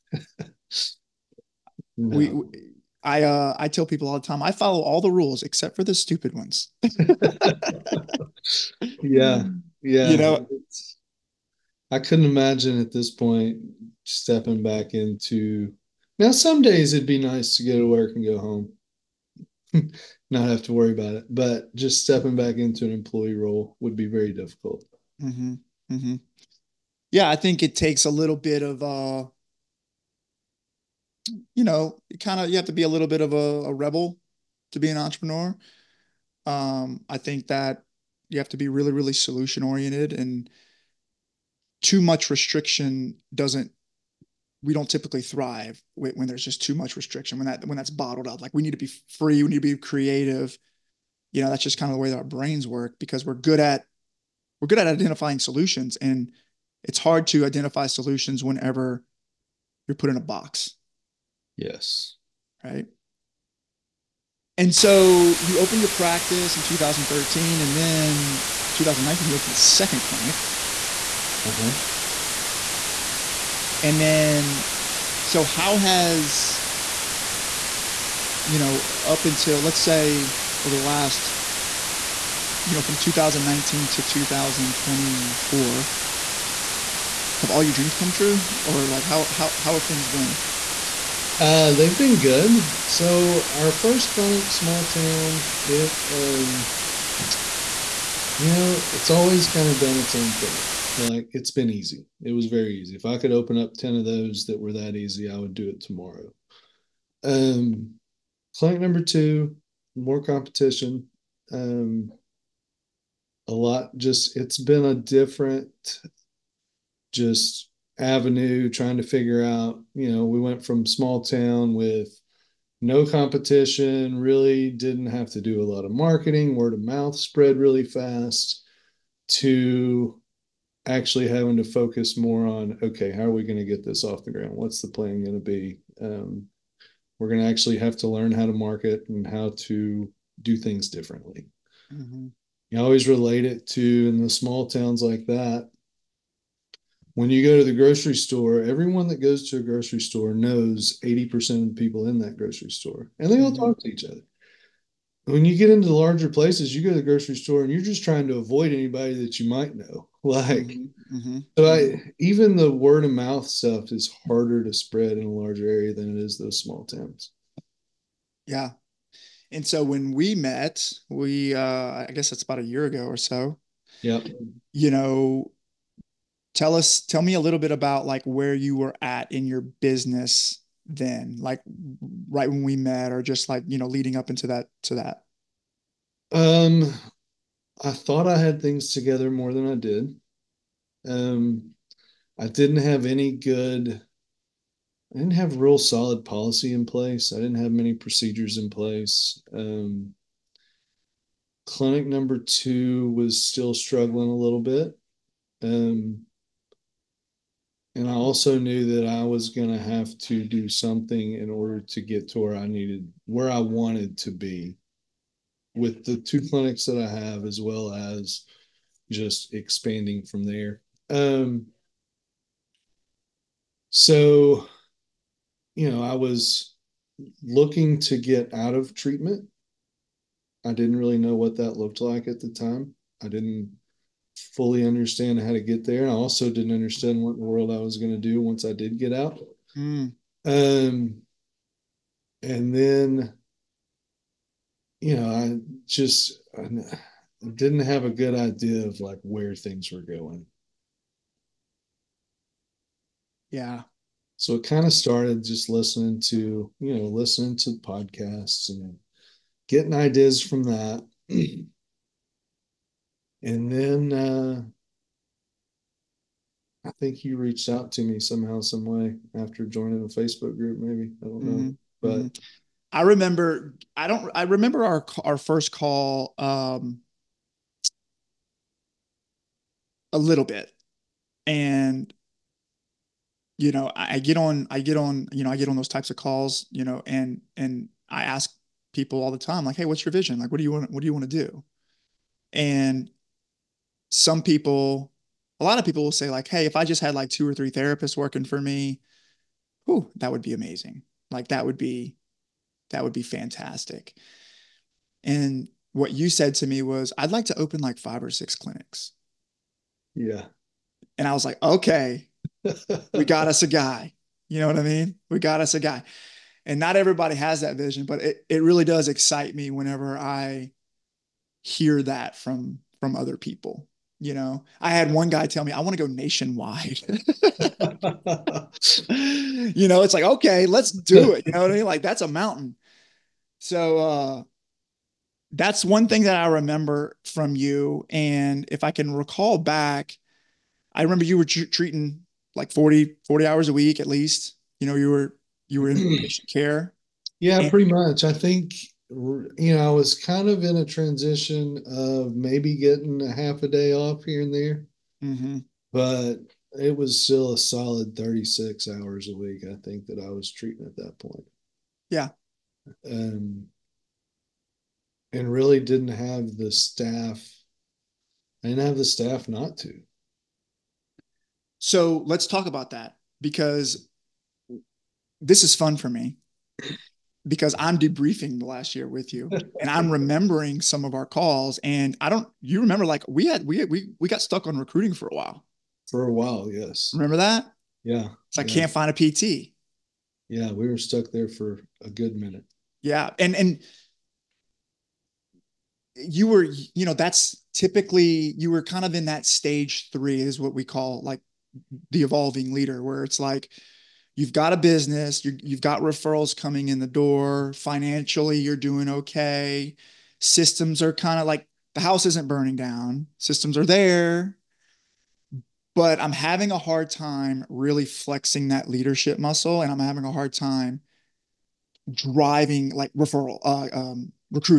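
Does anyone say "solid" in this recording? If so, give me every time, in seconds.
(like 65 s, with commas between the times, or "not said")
195 s, 357 s.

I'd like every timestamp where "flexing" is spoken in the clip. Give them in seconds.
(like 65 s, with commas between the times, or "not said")
418 s.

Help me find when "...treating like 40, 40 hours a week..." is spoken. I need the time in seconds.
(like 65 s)
341 s.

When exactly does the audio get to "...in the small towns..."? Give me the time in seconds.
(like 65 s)
144 s.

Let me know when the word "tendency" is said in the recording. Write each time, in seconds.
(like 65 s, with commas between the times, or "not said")
not said.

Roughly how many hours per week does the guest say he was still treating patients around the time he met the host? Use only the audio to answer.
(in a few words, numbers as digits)
36.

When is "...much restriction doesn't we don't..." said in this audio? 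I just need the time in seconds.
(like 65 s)
42 s.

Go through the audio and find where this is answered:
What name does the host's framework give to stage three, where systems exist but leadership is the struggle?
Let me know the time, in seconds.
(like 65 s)
402 s.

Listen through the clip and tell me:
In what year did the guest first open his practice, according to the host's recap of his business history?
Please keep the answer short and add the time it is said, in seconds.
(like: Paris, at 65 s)
2013, at 66 s.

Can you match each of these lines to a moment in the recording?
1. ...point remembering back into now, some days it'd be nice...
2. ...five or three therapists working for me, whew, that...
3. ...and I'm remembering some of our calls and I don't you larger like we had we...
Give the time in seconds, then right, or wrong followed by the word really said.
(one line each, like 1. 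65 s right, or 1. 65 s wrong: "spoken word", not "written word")
1. 13 s wrong: "stepping", not "remembering"
2. 297 s wrong: "two", not "five"
3. 379 s wrong: "remember", not "larger".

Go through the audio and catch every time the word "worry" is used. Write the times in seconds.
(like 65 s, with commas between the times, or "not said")
20 s.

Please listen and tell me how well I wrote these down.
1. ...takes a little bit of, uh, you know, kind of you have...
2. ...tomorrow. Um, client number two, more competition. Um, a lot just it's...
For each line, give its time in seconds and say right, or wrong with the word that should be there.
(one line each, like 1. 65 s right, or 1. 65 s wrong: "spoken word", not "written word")
1. 27 s right
2. 105 s right.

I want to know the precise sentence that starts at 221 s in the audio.
Um, so, you know, I was looking to get out of treatment.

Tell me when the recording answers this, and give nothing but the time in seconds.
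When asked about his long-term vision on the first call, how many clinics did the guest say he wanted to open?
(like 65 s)
307 s.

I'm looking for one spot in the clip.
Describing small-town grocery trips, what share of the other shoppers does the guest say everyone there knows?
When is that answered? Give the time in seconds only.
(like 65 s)
151 s.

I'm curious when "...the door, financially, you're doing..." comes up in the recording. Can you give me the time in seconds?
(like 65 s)
406 s.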